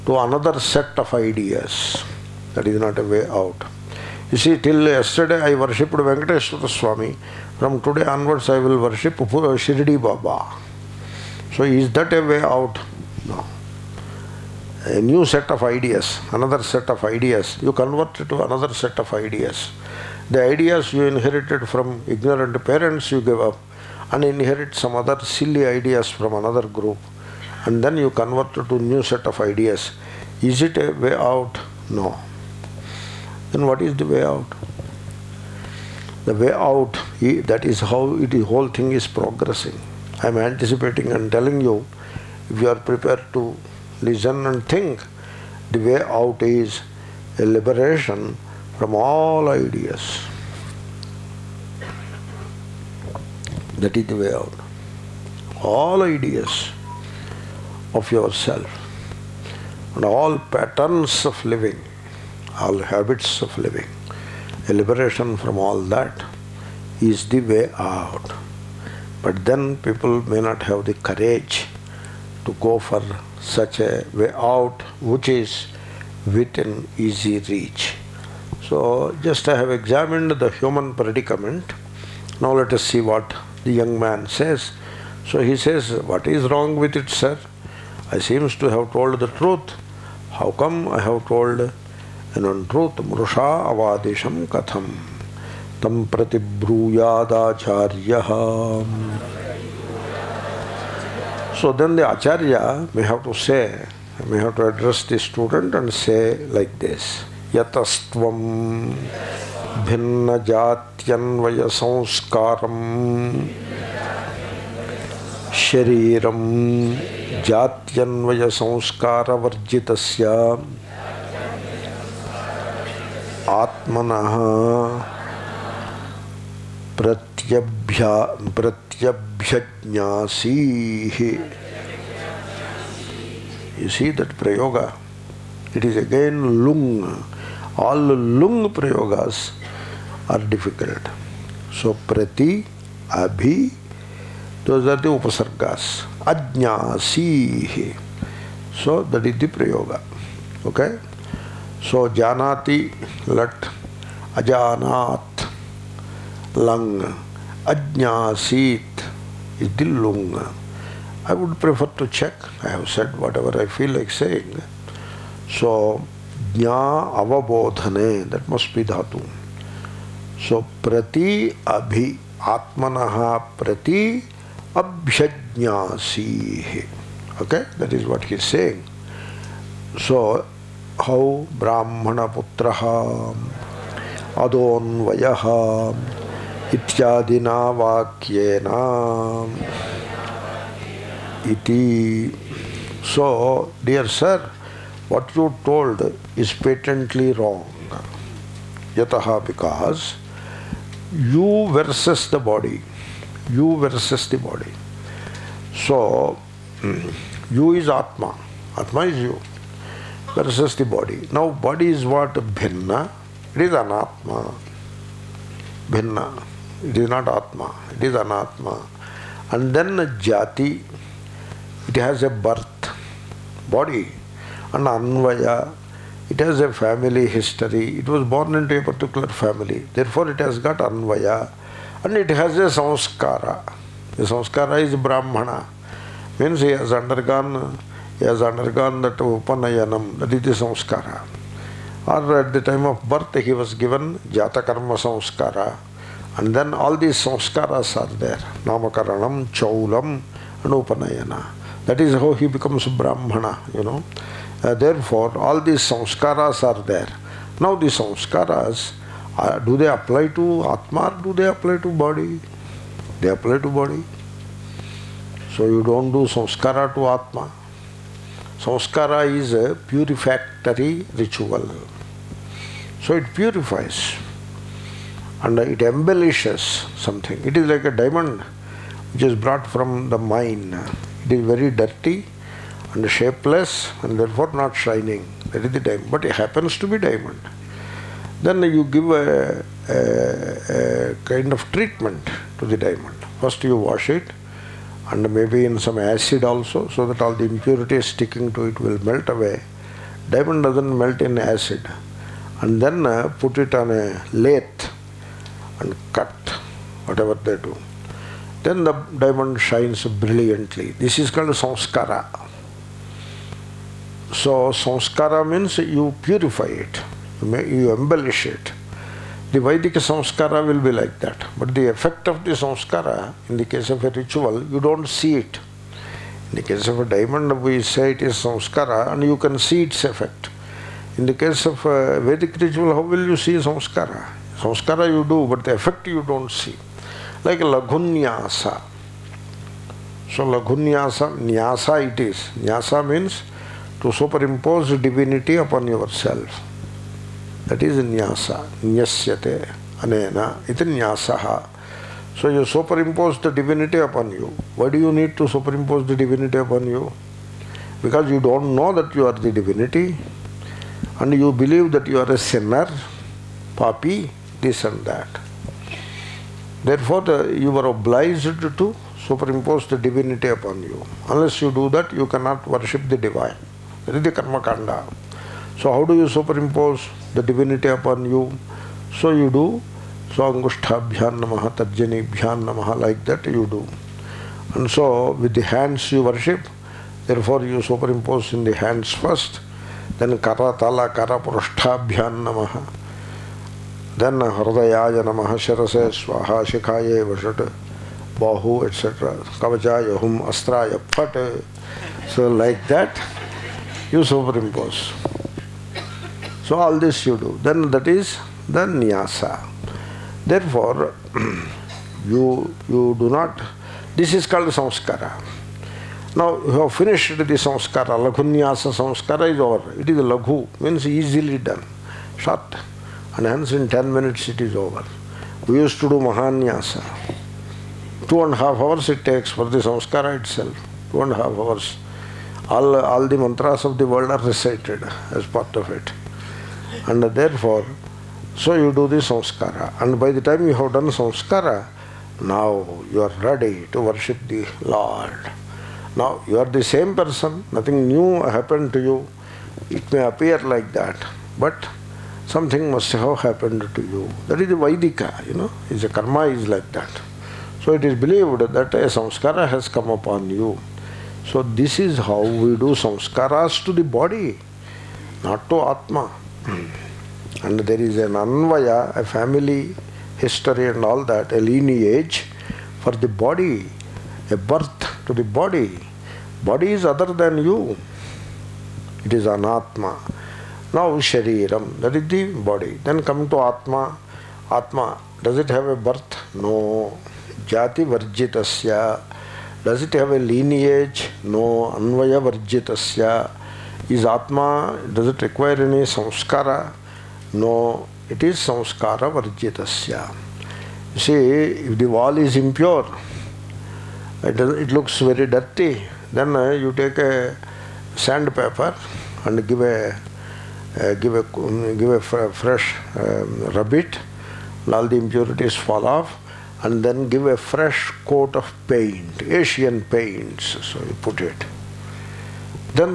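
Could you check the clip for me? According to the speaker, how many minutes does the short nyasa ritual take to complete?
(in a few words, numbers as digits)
10.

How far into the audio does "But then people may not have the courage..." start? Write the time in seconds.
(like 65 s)
69 s.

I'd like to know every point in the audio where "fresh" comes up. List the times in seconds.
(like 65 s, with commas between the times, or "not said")
512 s, 517 s.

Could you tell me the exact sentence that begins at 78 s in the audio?
So, just I have examined the human predicament.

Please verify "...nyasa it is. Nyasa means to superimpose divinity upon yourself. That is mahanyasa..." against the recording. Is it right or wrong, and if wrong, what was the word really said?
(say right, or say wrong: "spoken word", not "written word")
wrong: "nyasa", not "mahanyasa".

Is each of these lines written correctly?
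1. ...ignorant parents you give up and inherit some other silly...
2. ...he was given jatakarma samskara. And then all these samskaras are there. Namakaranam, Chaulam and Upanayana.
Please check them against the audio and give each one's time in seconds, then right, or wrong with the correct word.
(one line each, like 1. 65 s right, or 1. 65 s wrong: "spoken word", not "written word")
1. 22 s right
2. 243 s right.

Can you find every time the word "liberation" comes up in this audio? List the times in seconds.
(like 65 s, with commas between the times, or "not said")
47 s, 64 s.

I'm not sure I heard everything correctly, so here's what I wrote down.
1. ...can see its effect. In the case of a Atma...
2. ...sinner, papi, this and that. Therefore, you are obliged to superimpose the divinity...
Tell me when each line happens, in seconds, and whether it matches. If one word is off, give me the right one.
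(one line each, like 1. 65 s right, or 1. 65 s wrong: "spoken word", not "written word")
1. 329 s wrong: "Vedic", not "Atma"
2. 362 s right.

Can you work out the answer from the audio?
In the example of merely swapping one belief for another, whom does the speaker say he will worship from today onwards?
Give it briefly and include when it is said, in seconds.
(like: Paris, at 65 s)
Shirdi Baba, at 9 s.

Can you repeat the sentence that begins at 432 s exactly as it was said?
All all the mantras of the world are recited as part of it.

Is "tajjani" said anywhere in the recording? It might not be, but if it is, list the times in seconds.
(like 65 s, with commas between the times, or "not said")
381 s.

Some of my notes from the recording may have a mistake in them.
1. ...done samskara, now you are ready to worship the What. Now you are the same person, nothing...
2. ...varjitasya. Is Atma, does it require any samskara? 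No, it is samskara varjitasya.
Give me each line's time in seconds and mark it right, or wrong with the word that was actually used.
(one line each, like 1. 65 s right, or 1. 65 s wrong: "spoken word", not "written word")
1. 440 s wrong: "Lord", not "What"
2. 492 s right.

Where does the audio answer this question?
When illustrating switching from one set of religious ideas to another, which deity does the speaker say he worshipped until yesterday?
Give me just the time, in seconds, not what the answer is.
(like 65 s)
5 s.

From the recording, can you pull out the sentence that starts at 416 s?
Now you have finished the samskara.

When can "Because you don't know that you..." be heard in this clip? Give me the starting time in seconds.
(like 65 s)
358 s.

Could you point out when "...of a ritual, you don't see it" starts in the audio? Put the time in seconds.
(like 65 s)
323 s.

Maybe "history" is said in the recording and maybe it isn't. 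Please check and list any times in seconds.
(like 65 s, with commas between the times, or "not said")
227 s, 470 s.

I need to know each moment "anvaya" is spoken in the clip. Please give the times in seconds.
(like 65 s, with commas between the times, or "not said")
224 s, 230 s, 468 s, 491 s.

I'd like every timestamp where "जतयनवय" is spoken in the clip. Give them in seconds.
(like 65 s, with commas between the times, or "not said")
110 s, 117 s.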